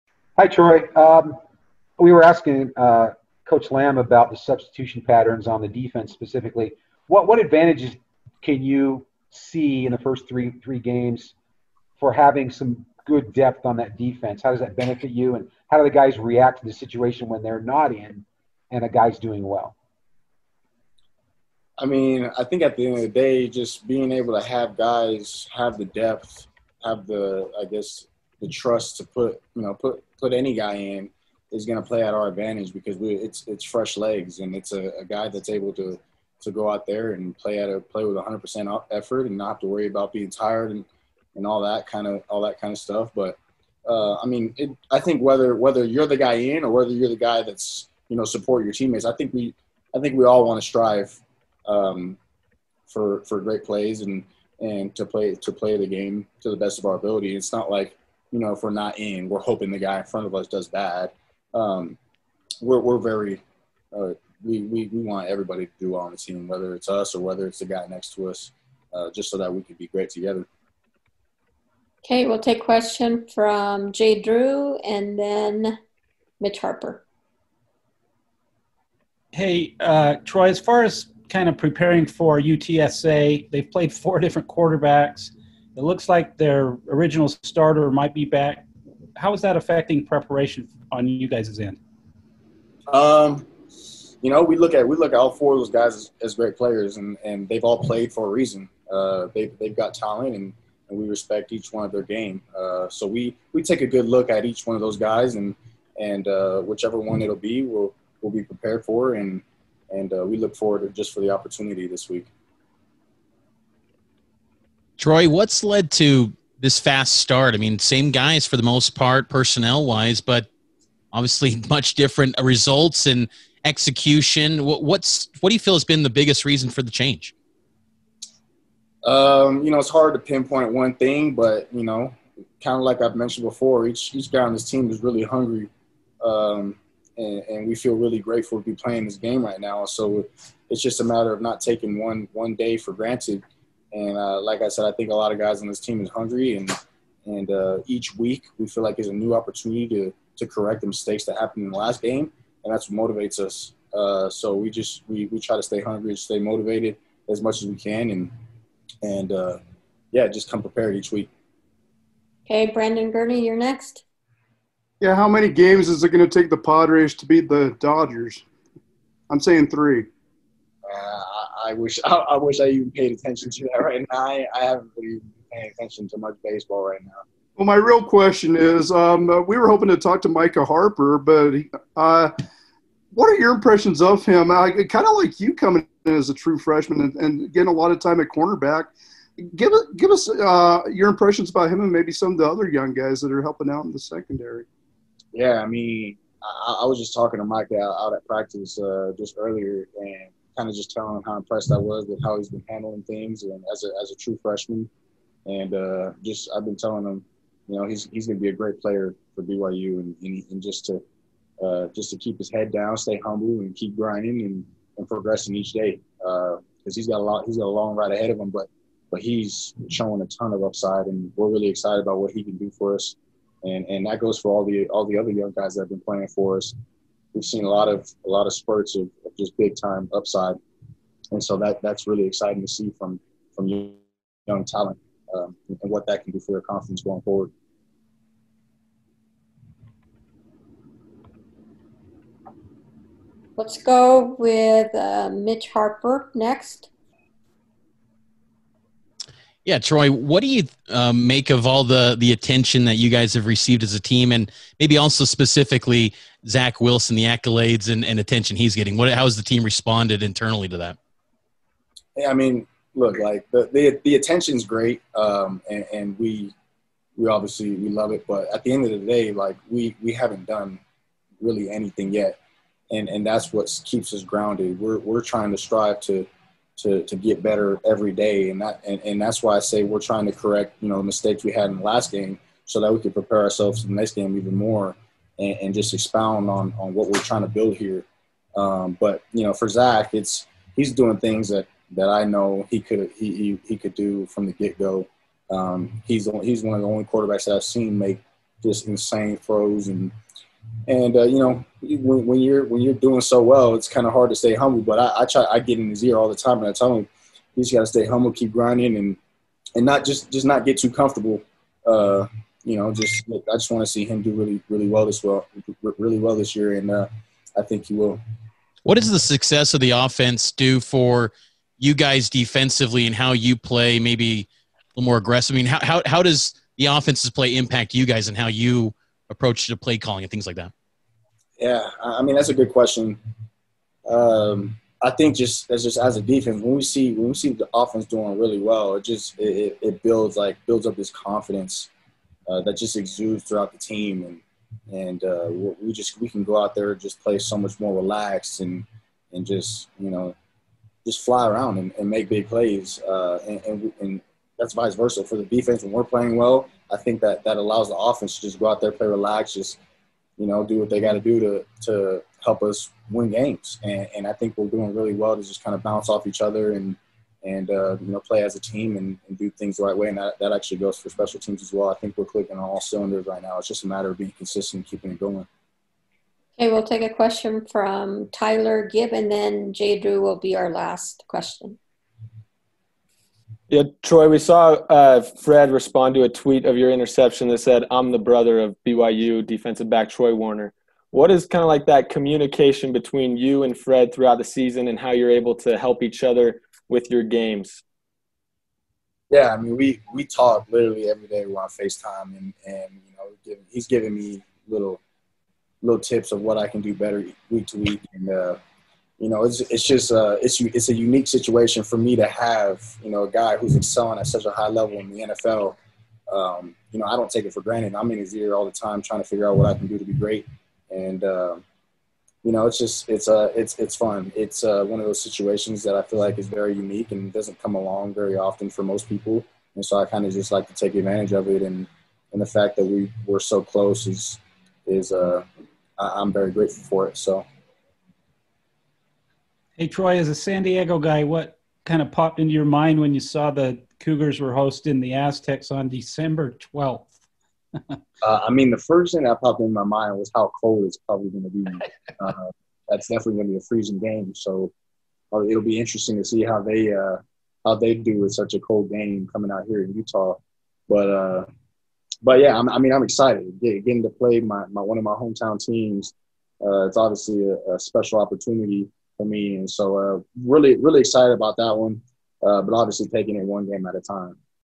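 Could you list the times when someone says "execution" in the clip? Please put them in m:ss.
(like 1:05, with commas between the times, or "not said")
2:03.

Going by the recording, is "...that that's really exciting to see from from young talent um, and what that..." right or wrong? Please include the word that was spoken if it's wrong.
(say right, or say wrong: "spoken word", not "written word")
right.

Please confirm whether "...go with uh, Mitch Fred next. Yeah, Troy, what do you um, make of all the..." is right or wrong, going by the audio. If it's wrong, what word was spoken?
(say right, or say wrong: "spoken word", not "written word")
wrong: "Harper", not "Fred".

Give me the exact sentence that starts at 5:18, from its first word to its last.
What does the success of the offense do for you guys defensively and how you play?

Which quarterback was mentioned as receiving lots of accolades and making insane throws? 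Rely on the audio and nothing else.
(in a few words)
Zach Wilson.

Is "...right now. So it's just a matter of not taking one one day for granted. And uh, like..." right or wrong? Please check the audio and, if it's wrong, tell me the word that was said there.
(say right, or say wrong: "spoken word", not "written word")
right.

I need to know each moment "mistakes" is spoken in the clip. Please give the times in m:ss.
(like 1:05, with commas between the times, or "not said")
2:30, 4:41.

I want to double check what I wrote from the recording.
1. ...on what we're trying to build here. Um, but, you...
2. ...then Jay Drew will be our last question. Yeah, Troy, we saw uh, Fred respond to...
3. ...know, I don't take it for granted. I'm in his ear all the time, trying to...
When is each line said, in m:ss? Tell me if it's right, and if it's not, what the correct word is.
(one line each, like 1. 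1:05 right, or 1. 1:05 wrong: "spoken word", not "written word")
1. 4:46 right
2. 6:19 right
3. 6:56 right.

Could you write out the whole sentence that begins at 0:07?
What what advantages can you see in the first three three games for having some good depth on that defense?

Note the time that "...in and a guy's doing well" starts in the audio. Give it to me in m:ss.
0:17.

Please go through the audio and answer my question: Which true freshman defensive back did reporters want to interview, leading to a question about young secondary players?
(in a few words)
Micah Harper.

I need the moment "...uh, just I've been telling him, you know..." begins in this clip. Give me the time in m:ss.
3:25.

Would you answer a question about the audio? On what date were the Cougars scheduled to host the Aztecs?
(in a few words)
December 12th.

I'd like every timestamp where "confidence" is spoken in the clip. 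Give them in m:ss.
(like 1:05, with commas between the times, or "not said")
3:56, 5:41.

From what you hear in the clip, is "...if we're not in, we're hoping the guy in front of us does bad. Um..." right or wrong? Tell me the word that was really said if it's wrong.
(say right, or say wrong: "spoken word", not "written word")
right.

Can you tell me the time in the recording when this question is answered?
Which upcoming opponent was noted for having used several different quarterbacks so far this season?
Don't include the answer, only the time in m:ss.
1:22.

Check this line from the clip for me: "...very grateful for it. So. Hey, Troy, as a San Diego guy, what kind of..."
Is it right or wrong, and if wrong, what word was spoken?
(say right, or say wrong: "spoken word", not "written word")
right.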